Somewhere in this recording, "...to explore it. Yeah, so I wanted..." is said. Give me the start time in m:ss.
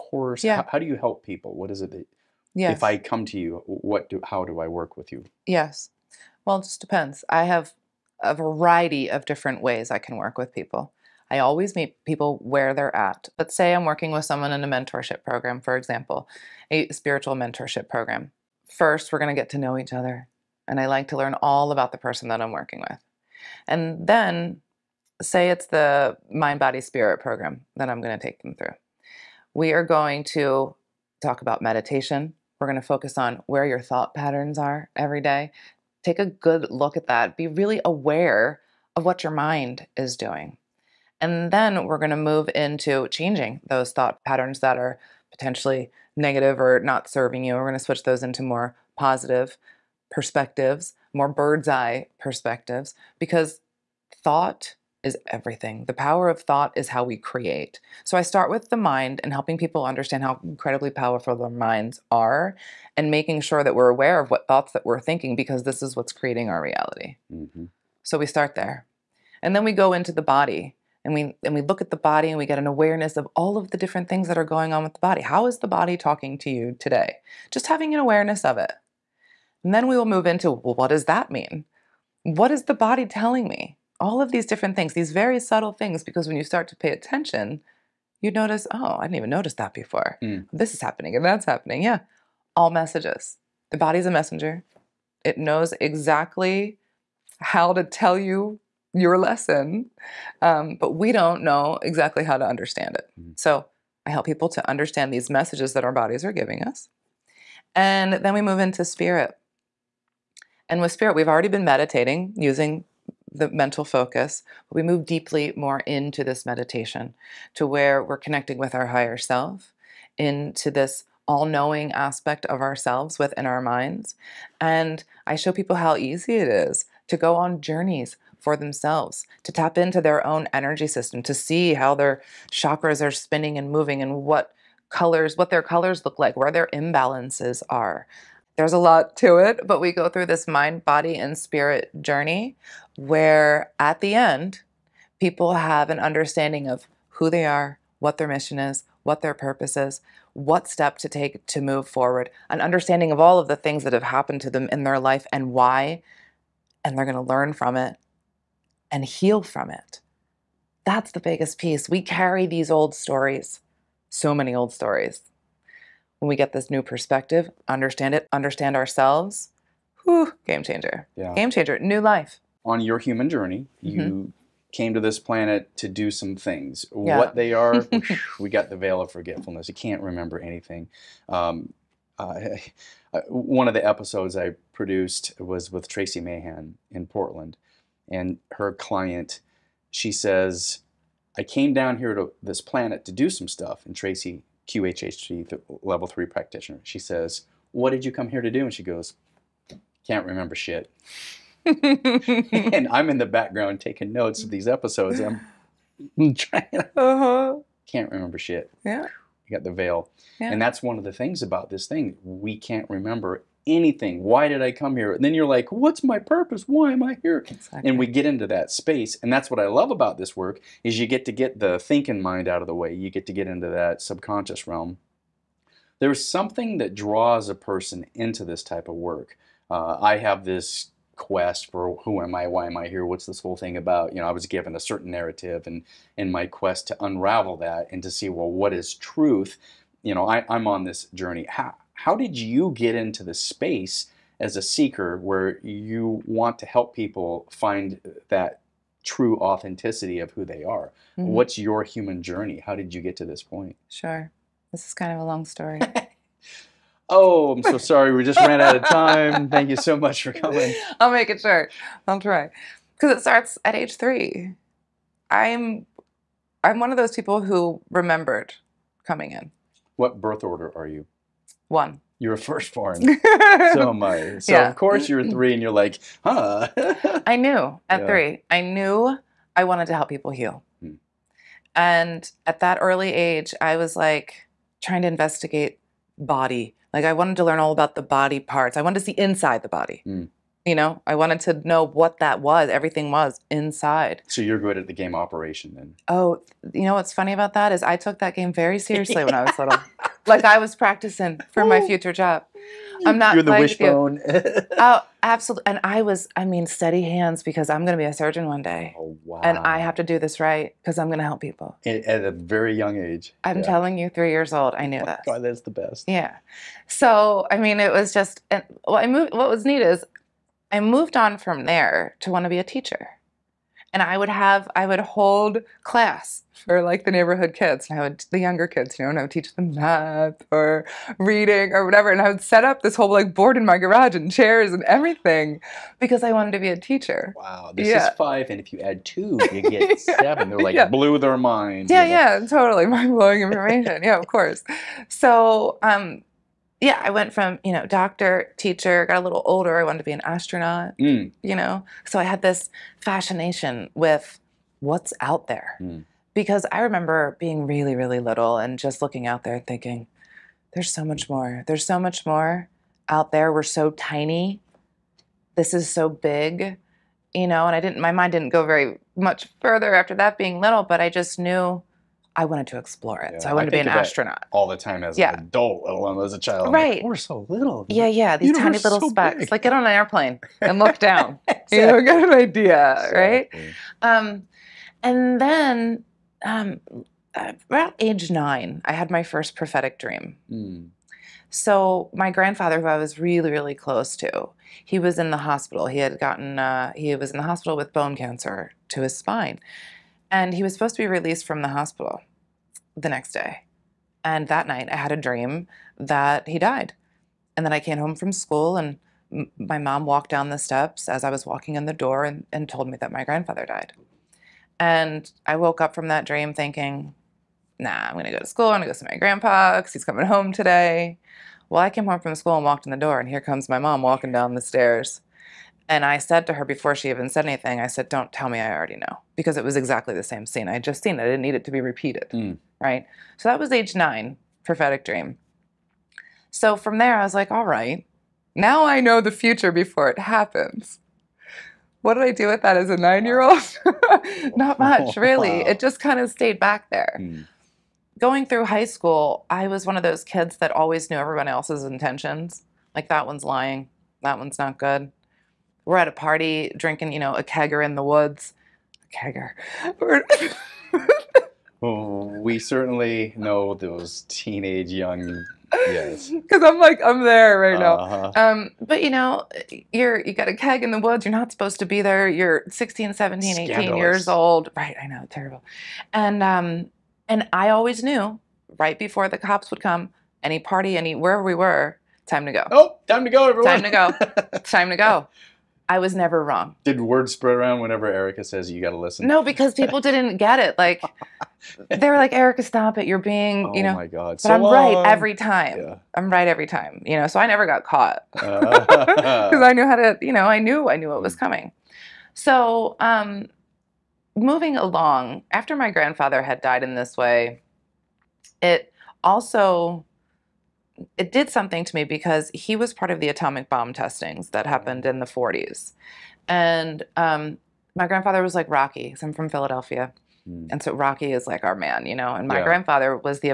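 6:12.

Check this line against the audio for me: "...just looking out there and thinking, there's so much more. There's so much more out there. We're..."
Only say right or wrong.
right.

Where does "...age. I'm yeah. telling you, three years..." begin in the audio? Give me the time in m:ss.
5:13.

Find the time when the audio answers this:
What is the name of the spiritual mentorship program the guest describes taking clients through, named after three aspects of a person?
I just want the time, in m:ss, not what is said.
0:26.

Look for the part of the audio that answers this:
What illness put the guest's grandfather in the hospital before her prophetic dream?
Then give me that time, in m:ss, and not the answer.
6:37.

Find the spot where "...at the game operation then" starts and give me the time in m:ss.
4:54.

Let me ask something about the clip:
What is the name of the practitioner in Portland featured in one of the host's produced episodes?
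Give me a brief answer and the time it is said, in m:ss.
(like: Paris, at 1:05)
Tracie Mahan, at 3:05.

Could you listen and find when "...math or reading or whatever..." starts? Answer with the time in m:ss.
5:29.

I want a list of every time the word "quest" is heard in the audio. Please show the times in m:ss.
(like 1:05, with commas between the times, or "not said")
3:51, 3:56.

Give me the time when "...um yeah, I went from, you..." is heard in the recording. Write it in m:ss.
5:45.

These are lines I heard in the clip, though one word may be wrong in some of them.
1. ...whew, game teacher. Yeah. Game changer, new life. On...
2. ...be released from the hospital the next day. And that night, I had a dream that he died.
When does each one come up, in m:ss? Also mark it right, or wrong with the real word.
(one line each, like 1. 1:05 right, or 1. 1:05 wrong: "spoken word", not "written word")
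1. 2:50 wrong: "changer", not "teacher"
2. 6:41 right.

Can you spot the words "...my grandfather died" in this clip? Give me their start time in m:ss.
6:53.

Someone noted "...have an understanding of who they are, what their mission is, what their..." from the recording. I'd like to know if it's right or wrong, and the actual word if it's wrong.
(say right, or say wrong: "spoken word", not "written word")
right.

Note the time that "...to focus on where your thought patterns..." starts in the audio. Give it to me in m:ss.
0:32.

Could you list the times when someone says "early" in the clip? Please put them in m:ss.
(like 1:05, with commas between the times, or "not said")
4:42.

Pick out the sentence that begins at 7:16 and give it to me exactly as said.
So from there, I was like, All right, now I know the future before it happens.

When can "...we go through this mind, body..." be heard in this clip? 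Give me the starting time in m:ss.
2:19.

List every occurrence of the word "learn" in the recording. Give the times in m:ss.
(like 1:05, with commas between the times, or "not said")
0:21, 2:37, 4:47.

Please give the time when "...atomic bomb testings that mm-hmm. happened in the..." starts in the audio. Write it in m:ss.
8:33.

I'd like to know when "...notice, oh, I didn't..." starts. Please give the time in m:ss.
1:28.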